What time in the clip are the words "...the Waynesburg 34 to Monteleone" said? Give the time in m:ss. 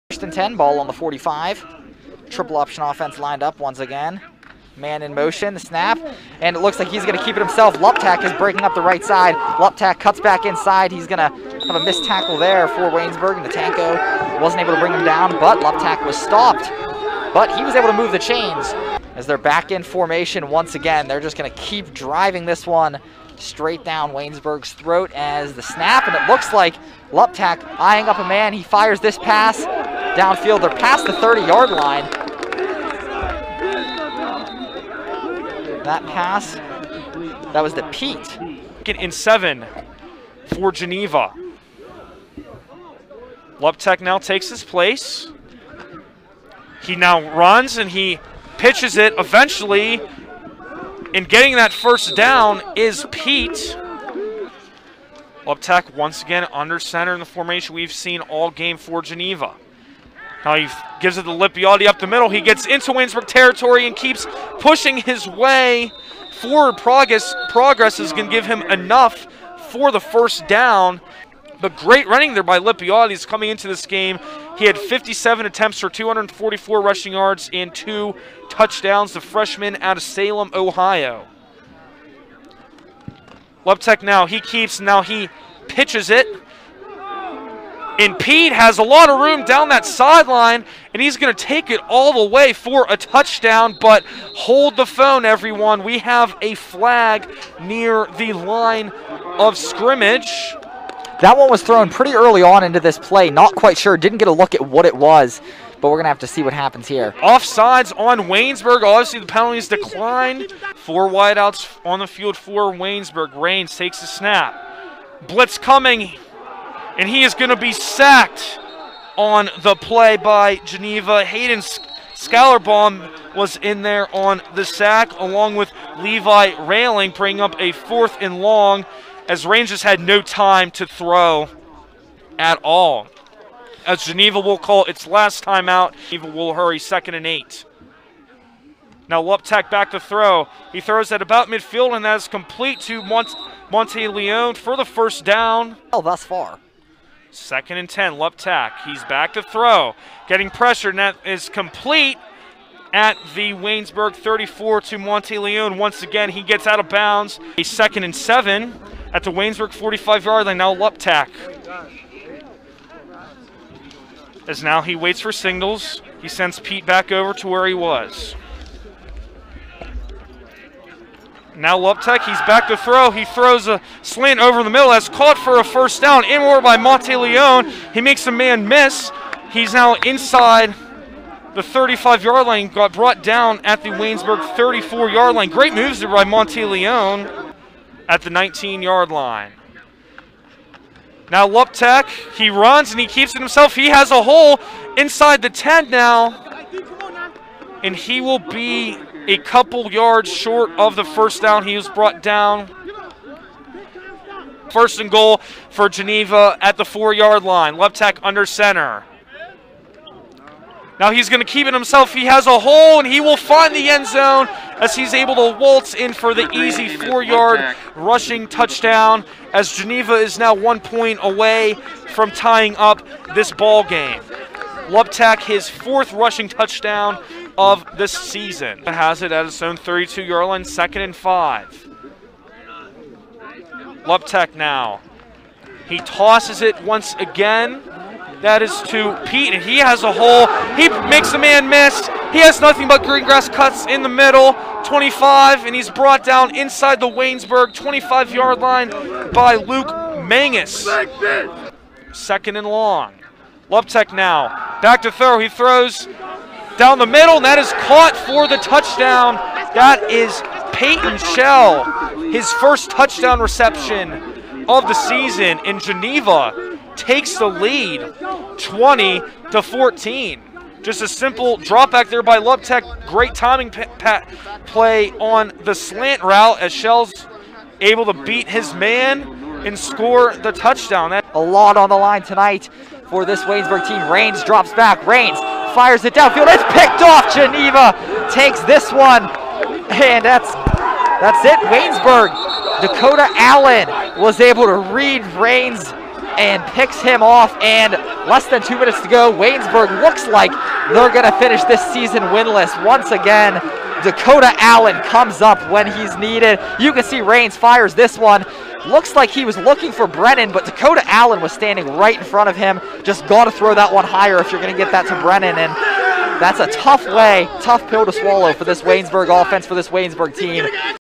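2:33.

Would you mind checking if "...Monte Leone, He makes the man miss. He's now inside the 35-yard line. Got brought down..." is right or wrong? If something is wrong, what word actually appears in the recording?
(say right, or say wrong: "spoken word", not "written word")
right.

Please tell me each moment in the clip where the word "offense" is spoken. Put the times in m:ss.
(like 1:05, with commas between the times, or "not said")
0:02, 5:19.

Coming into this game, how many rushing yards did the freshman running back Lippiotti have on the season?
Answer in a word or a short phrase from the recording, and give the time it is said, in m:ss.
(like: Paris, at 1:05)
244, at 1:15.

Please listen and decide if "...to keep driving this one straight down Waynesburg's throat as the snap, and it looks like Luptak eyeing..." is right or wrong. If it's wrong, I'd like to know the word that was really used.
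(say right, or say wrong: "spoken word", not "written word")
right.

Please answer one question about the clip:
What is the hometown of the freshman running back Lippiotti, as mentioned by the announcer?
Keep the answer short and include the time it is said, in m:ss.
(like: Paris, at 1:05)
Salem, Ohio, at 1:20.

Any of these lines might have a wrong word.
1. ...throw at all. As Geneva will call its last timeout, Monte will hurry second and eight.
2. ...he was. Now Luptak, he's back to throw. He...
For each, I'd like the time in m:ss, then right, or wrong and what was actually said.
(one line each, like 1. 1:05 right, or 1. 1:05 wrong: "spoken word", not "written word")
1. 2:10 wrong: "Geneva", not "Monte"
2. 2:47 right.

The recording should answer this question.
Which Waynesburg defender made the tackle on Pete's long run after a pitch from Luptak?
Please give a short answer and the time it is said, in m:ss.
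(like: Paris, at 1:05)
Luke Mangus, at 4:09.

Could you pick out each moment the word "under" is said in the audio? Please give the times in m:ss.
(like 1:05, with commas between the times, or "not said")
0:56, 3:28.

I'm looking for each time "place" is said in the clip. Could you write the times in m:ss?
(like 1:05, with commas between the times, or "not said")
0:44.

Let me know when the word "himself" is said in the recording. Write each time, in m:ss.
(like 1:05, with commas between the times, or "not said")
0:07, 3:13, 3:31.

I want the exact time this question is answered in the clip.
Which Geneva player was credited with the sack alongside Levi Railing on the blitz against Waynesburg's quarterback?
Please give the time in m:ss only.
2:01.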